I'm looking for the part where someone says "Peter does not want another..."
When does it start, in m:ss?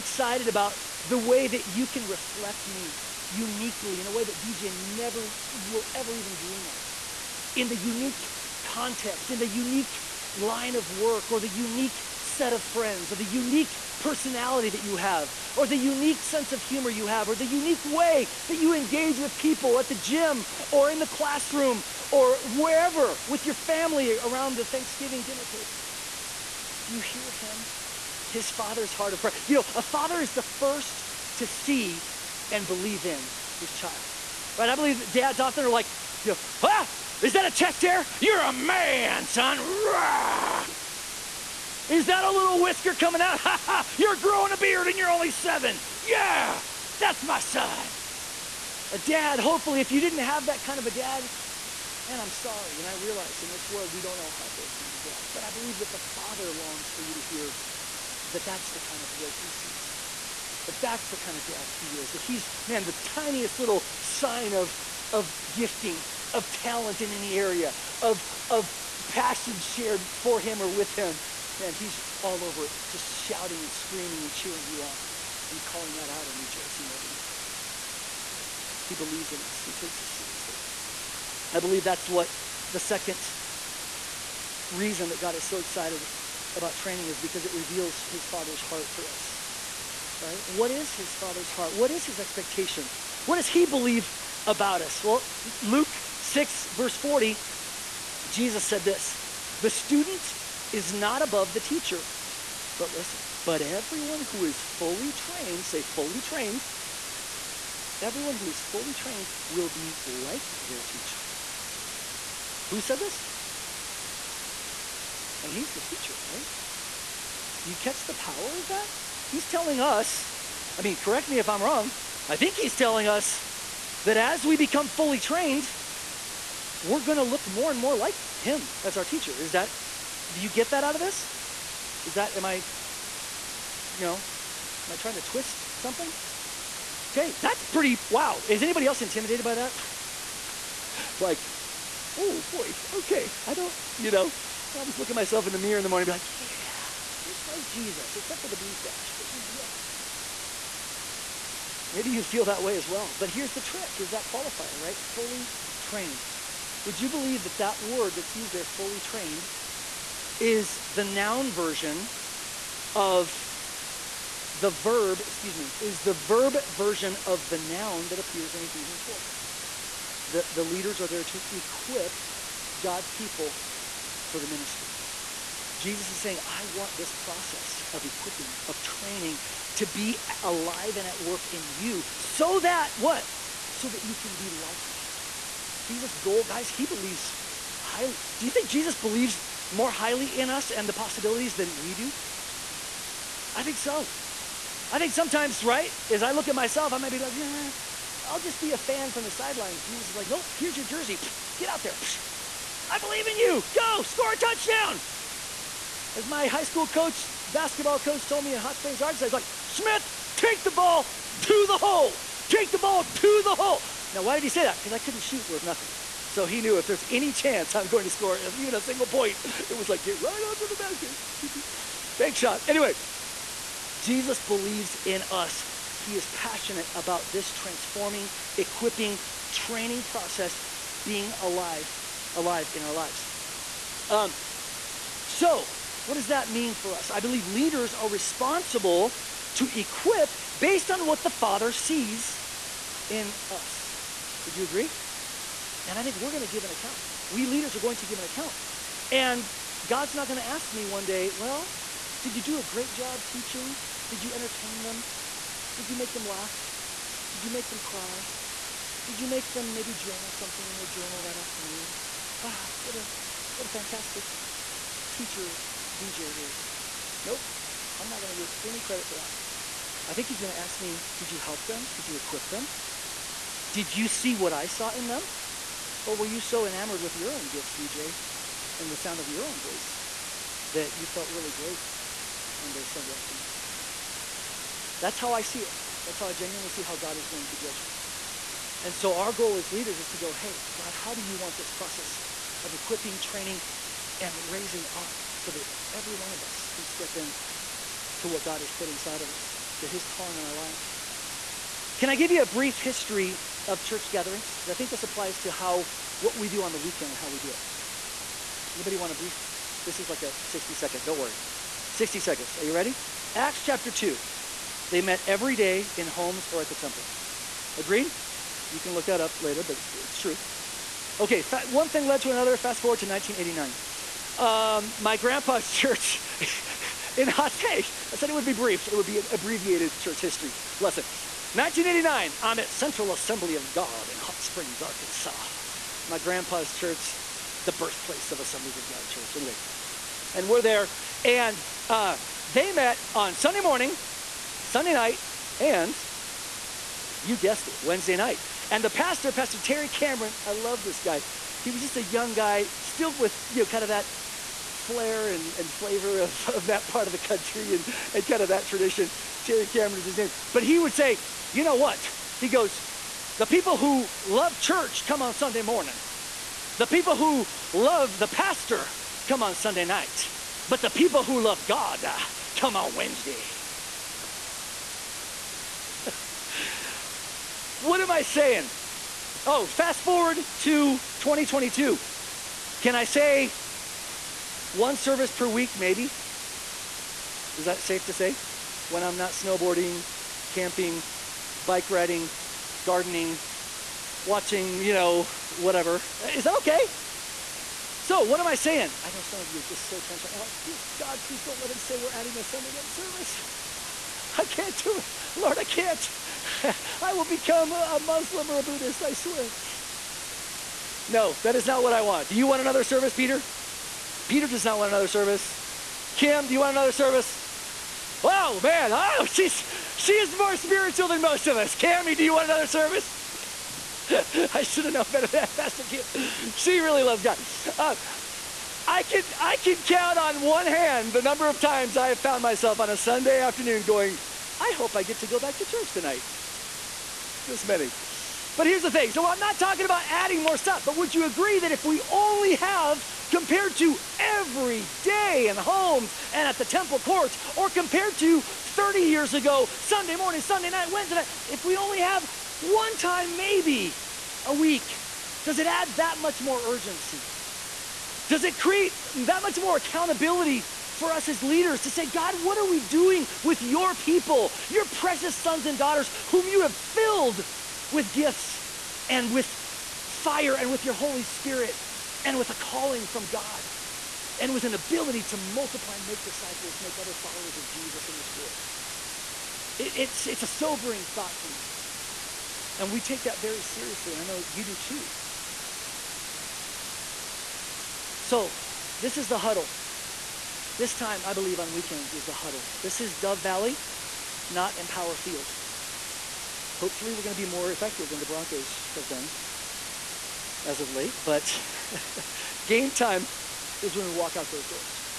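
6:54.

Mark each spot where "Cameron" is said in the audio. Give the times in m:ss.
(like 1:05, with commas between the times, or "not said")
5:49, 5:59.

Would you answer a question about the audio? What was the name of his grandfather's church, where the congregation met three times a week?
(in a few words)
Central Assembly of God.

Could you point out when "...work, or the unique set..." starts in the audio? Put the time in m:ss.
0:10.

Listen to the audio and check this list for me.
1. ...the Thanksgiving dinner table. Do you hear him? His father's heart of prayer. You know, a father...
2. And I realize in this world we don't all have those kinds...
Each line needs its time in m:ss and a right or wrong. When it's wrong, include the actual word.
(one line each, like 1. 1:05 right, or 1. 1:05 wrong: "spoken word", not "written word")
1. 0:24 right
2. 0:52 right.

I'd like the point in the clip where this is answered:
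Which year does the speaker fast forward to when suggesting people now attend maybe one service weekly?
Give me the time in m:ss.
6:21.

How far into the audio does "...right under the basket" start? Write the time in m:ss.
3:40.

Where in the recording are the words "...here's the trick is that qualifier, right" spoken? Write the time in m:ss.
2:33.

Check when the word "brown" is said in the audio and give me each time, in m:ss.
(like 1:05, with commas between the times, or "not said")
not said.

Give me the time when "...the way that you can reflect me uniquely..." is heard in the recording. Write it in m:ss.
0:01.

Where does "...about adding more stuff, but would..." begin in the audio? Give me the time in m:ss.
7:19.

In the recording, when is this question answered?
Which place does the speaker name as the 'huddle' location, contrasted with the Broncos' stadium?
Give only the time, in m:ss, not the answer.
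8:13.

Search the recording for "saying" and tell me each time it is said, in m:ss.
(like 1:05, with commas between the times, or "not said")
2:56, 6:18, 6:38.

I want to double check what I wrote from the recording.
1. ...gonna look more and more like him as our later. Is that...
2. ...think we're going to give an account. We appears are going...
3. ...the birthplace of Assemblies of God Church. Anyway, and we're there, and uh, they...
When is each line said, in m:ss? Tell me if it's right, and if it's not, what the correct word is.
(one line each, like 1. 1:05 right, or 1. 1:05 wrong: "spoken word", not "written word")
1. 2:07 wrong: "teacher", not "later"
2. 4:06 wrong: "leaders", not "appears"
3. 5:37 right.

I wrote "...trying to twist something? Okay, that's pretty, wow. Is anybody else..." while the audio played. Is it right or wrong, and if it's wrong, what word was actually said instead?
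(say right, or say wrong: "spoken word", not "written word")
right.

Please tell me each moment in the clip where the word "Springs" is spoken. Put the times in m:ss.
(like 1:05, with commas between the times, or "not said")
3:28, 5:34.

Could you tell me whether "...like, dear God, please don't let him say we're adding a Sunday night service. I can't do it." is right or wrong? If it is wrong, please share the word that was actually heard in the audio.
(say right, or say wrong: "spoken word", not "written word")
right.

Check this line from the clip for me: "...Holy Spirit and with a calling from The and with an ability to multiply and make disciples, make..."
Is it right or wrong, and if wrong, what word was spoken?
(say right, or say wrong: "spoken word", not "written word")
wrong: "God", not "The".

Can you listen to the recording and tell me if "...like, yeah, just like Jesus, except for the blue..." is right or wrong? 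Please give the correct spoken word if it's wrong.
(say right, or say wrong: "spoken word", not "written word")
right.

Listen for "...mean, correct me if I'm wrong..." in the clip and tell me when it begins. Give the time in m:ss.
2:00.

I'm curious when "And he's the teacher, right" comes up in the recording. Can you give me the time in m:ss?
1:55.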